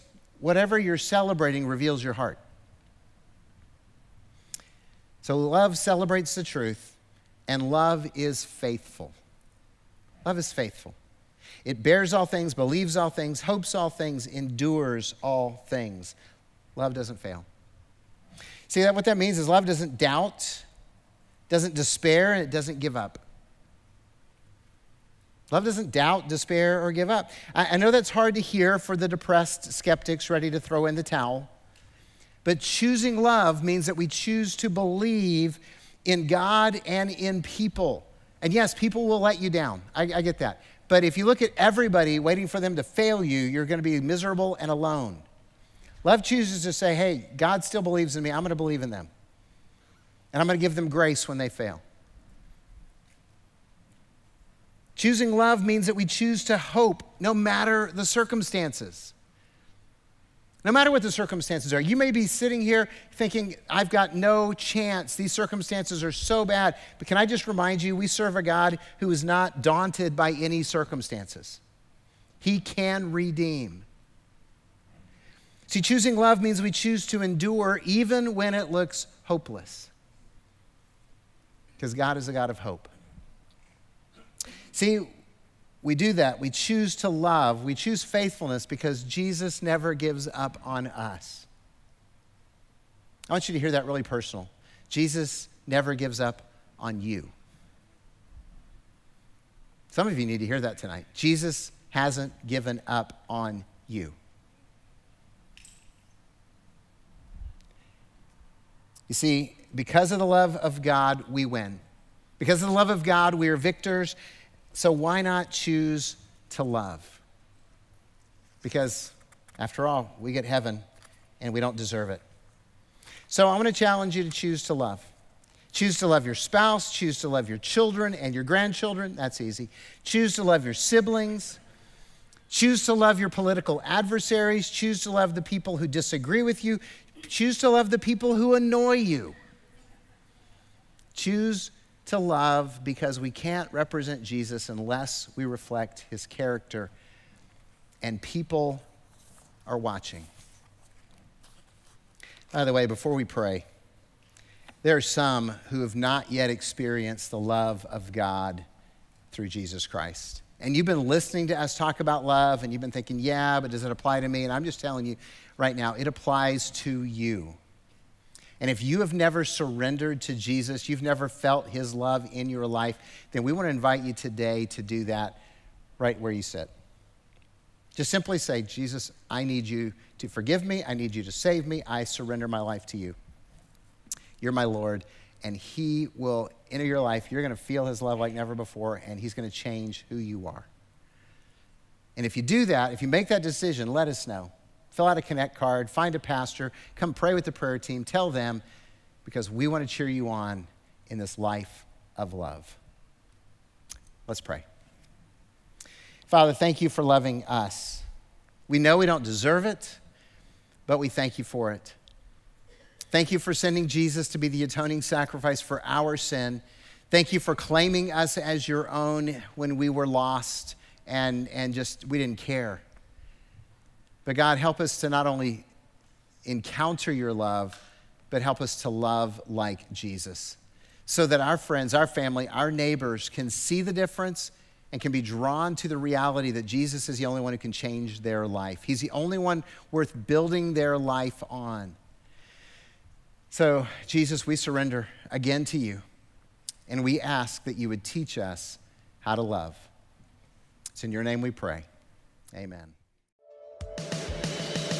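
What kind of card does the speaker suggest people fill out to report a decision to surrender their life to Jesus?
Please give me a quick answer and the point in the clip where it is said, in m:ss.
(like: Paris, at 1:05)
Connect card, at 3:15.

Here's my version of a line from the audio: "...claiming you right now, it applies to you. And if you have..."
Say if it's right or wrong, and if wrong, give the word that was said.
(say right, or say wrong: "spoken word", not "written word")
wrong: "telling", not "claiming".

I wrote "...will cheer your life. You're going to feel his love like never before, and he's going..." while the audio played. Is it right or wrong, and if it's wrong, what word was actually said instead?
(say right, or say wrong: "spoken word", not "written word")
wrong: "enter", not "cheer".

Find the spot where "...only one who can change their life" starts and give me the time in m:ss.
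3:57.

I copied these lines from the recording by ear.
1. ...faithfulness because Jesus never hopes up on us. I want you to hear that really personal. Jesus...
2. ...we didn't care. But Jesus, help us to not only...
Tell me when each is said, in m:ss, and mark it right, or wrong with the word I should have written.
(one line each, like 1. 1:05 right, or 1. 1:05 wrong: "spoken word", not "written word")
1. 1:28 wrong: "gives", not "hopes"
2. 3:42 wrong: "God", not "Jesus".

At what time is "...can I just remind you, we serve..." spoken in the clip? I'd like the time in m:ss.
1:07.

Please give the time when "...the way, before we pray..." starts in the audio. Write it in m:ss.
2:32.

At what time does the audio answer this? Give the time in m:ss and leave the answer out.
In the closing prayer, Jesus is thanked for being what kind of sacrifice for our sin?
3:34.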